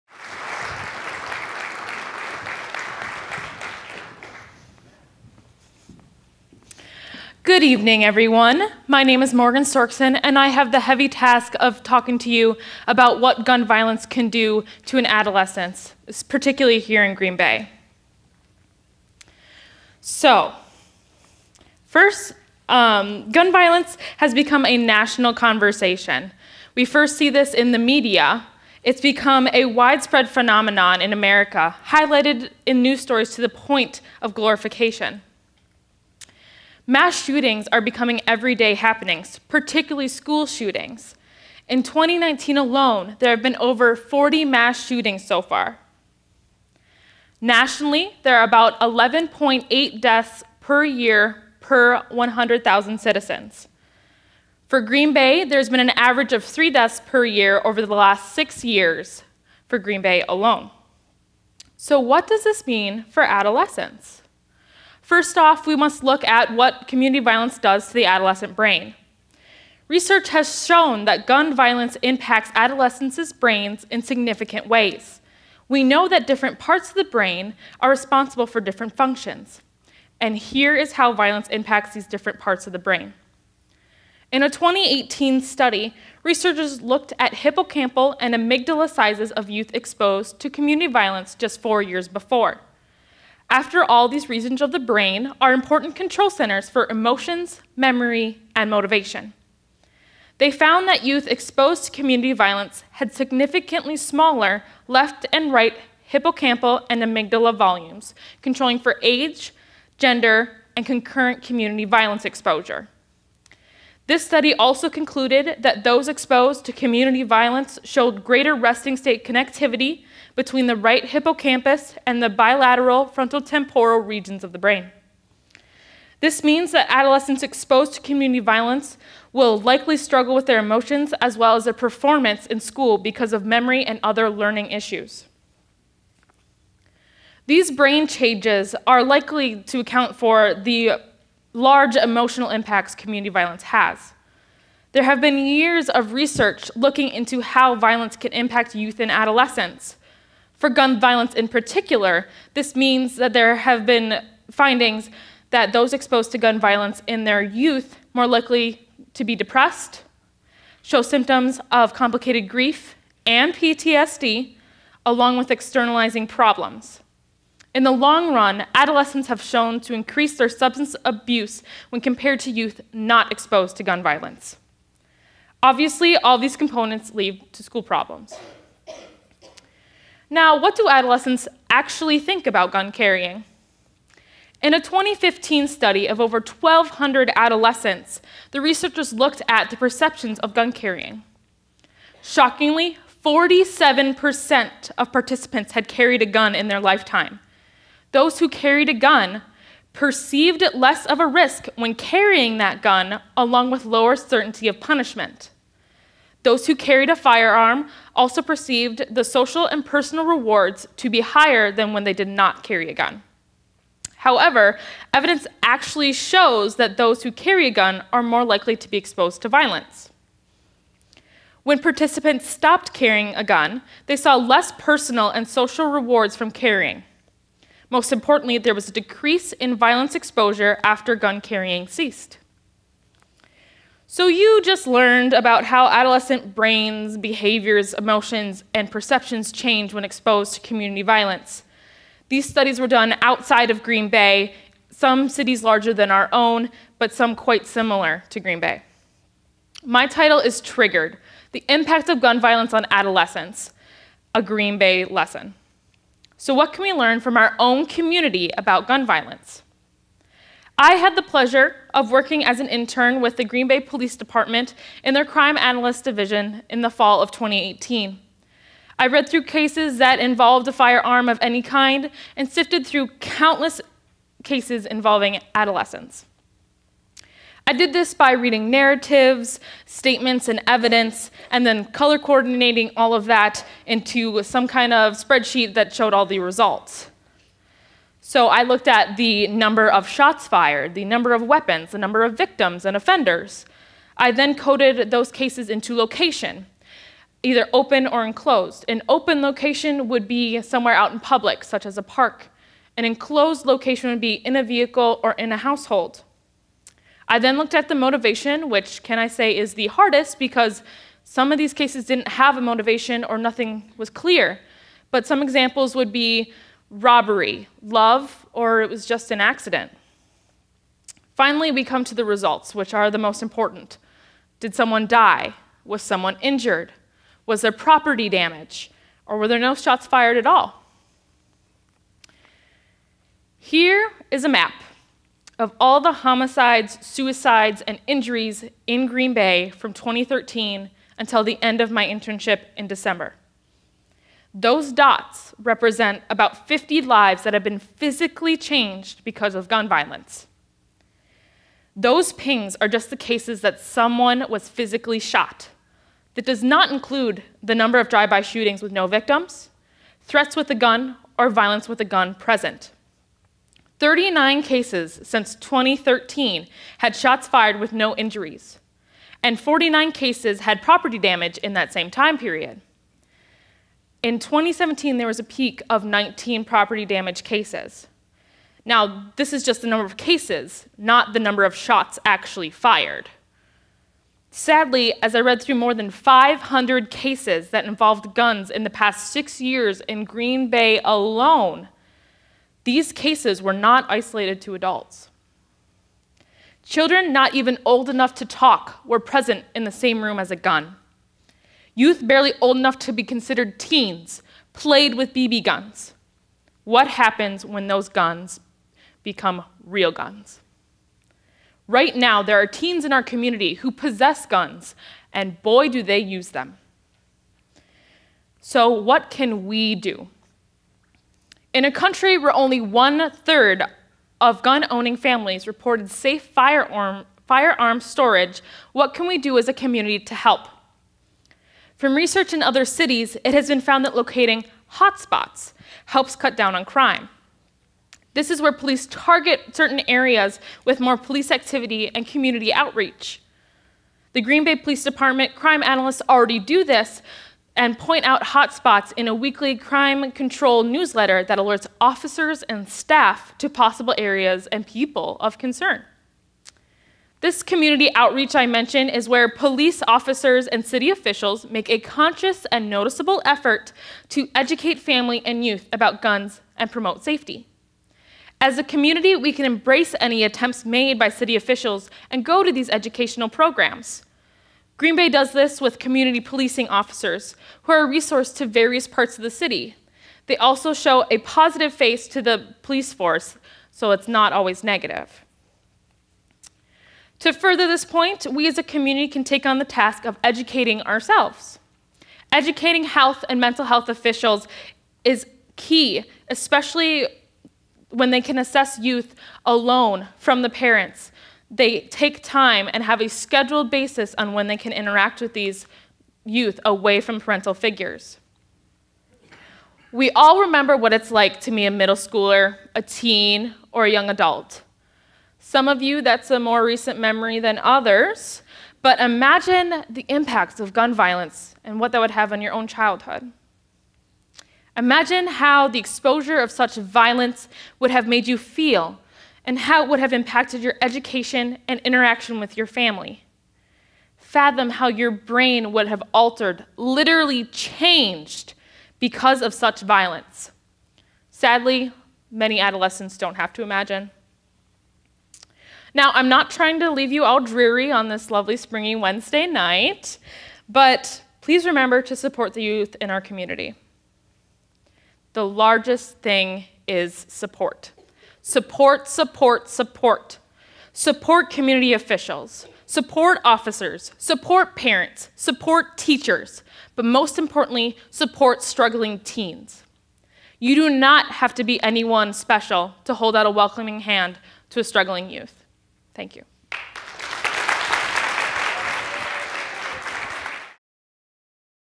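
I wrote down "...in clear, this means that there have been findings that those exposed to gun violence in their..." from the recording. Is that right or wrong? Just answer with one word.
wrong.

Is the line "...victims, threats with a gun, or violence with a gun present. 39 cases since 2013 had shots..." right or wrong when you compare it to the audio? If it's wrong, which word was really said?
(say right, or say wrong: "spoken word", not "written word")
right.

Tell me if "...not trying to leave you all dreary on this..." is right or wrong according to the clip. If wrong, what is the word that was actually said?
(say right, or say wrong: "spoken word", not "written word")
right.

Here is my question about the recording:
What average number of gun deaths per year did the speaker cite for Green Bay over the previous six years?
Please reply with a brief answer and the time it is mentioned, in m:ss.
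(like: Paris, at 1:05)
3, at 0:56.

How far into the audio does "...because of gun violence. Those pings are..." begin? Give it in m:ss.
5:49.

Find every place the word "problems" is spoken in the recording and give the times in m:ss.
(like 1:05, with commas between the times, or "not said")
2:46, 2:57.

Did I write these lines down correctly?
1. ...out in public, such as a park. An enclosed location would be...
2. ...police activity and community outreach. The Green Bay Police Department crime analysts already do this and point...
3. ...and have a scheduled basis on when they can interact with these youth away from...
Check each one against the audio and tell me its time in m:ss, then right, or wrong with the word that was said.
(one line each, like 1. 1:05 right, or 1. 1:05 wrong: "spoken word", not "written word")
1. 5:00 right
2. 7:21 right
3. 8:22 right.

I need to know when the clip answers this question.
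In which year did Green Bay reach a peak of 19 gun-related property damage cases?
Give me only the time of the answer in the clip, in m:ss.
6:14.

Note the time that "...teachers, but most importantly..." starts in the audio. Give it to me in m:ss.
9:26.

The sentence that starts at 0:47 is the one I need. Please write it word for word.
Nationally, there are about 11.8 deaths per year per 100,000 citizens.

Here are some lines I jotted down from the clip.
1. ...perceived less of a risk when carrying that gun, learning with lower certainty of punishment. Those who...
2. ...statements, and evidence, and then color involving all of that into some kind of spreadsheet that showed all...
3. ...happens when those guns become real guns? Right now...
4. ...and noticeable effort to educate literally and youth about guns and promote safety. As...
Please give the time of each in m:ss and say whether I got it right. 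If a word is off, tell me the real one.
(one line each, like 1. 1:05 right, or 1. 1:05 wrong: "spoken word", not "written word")
1. 3:19 wrong: "along", not "learning"
2. 4:39 wrong: "coordinating", not "involving"
3. 6:47 right
4. 7:42 wrong: "family", not "literally".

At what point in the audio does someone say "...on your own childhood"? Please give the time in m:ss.
8:42.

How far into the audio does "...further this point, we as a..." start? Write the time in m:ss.
8:07.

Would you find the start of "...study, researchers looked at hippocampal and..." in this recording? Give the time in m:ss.
1:25.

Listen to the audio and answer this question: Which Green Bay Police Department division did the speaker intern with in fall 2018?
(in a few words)
Crime Analyst Division.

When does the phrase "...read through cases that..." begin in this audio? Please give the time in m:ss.
4:29.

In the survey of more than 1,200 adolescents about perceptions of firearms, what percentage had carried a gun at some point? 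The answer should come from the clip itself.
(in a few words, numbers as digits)
47%.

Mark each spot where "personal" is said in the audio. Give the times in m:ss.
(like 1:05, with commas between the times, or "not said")
3:29, 3:44.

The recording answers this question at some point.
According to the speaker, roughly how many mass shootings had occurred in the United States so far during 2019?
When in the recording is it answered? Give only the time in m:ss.
0:43.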